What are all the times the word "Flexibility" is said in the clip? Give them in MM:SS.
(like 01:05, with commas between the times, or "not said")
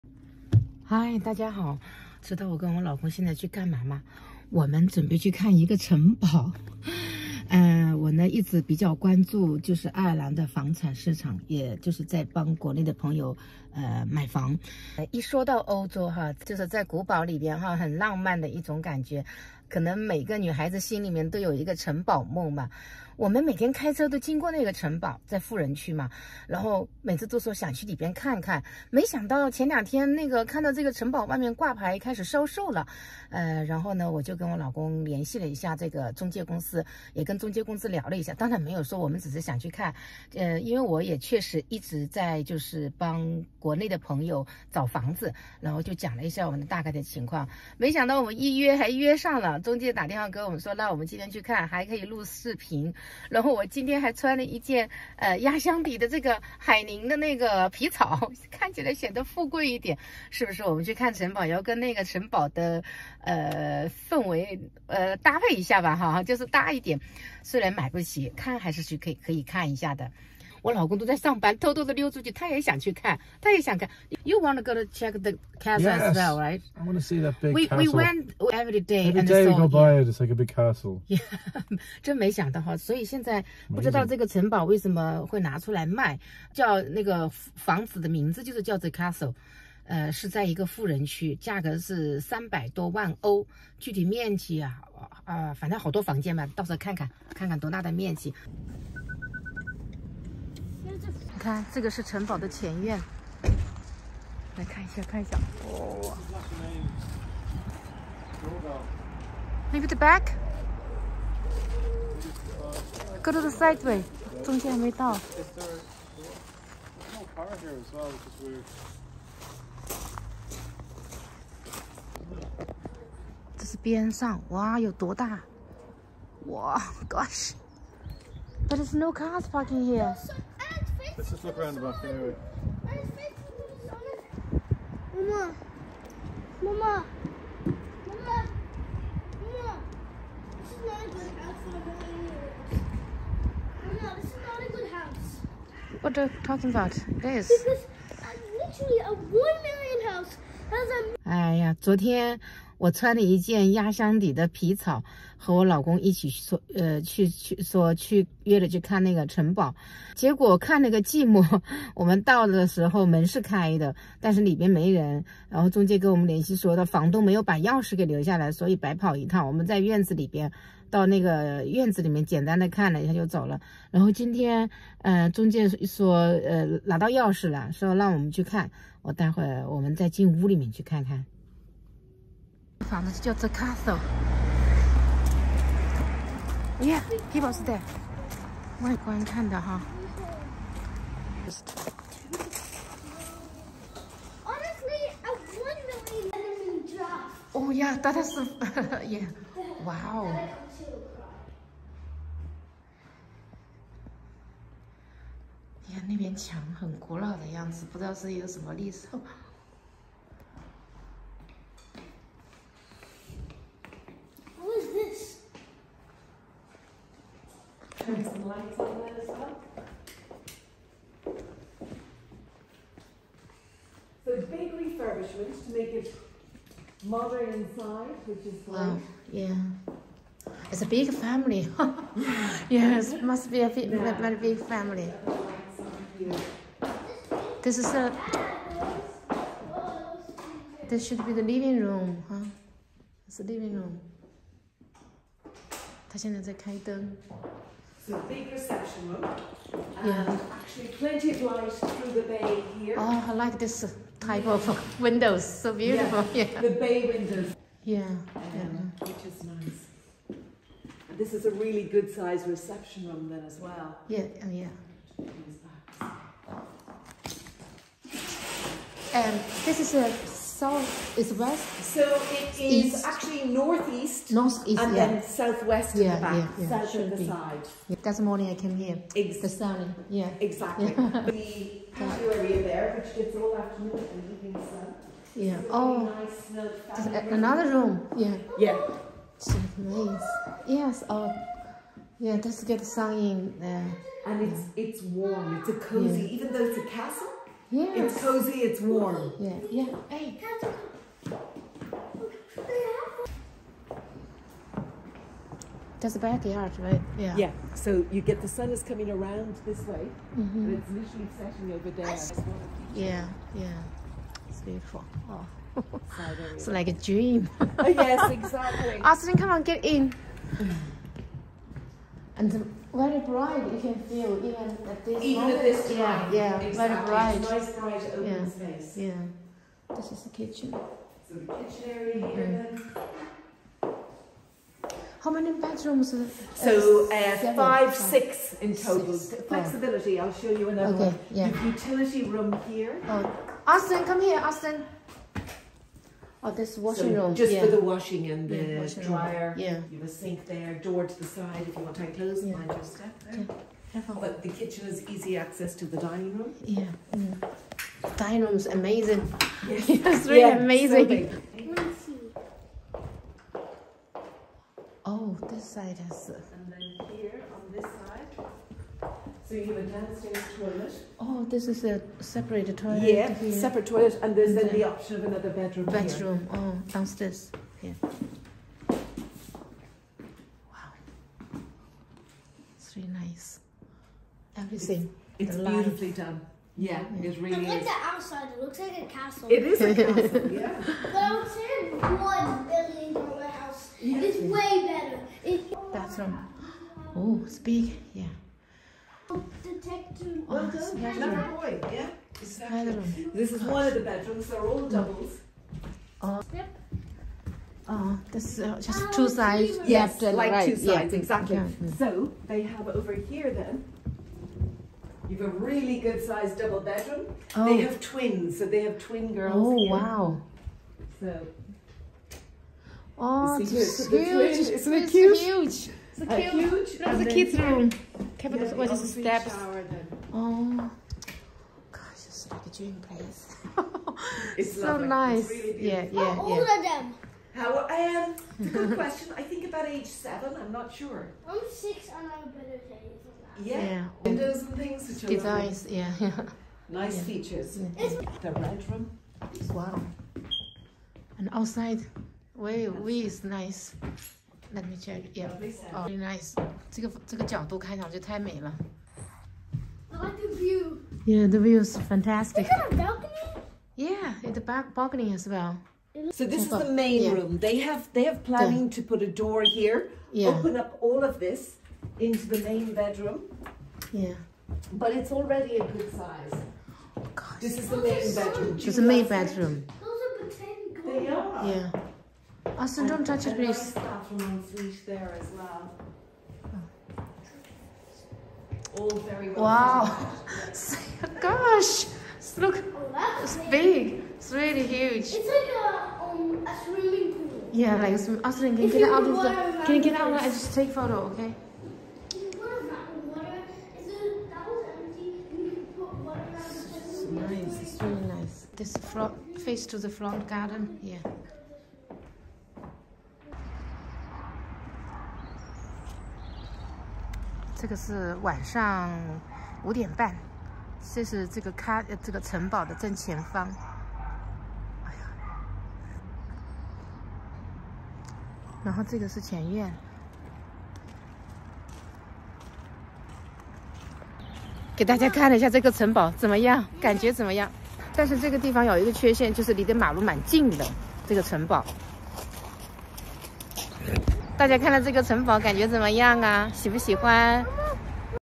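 05:39.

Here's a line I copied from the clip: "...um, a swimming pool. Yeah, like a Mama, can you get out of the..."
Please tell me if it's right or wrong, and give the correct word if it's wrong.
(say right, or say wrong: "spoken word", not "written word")
wrong: "Austin", not "Mama".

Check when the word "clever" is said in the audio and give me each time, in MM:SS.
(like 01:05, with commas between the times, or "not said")
06:41.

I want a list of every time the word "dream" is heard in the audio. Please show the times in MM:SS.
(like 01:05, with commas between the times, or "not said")
05:17, 07:12.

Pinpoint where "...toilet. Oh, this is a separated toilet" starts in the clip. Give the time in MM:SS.
06:10.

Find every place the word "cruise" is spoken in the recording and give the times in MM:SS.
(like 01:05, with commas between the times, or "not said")
not said.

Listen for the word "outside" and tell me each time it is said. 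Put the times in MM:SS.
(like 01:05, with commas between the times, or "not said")
06:28, 07:31.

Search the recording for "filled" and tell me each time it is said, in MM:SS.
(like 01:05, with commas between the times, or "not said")
not said.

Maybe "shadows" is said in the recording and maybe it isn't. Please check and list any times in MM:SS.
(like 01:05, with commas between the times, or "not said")
not said.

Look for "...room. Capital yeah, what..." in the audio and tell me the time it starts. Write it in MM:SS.
07:07.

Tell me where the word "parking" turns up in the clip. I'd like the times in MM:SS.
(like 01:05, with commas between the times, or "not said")
02:09.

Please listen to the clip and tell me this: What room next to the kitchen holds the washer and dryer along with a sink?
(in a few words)
Utility room.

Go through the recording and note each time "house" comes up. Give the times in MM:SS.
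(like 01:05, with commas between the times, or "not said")
02:30, 06:33.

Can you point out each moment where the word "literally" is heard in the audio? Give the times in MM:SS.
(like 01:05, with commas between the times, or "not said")
02:28, 05:10.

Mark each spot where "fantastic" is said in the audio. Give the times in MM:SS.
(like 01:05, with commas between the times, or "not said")
07:41.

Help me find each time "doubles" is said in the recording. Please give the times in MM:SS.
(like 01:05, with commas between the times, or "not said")
06:44, 06:56.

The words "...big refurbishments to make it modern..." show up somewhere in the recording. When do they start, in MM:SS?
03:44.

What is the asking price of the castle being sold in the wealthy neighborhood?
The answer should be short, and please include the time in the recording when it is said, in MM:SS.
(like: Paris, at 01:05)
Over 3 million euros, at 01:32.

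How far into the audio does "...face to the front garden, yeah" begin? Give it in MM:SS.
08:29.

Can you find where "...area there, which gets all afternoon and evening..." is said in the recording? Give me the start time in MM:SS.
04:42.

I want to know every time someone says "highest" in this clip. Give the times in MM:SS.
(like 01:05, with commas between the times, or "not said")
not said.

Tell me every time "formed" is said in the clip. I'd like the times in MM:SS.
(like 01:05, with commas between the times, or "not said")
not said.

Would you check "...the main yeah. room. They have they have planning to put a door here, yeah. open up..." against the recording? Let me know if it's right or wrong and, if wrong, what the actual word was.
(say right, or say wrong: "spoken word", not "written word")
right.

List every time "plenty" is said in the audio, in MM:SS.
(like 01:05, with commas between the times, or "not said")
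04:10.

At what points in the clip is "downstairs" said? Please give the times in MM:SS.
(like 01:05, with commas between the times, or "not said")
06:09, 06:16.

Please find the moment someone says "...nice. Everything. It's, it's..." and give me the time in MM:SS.
06:23.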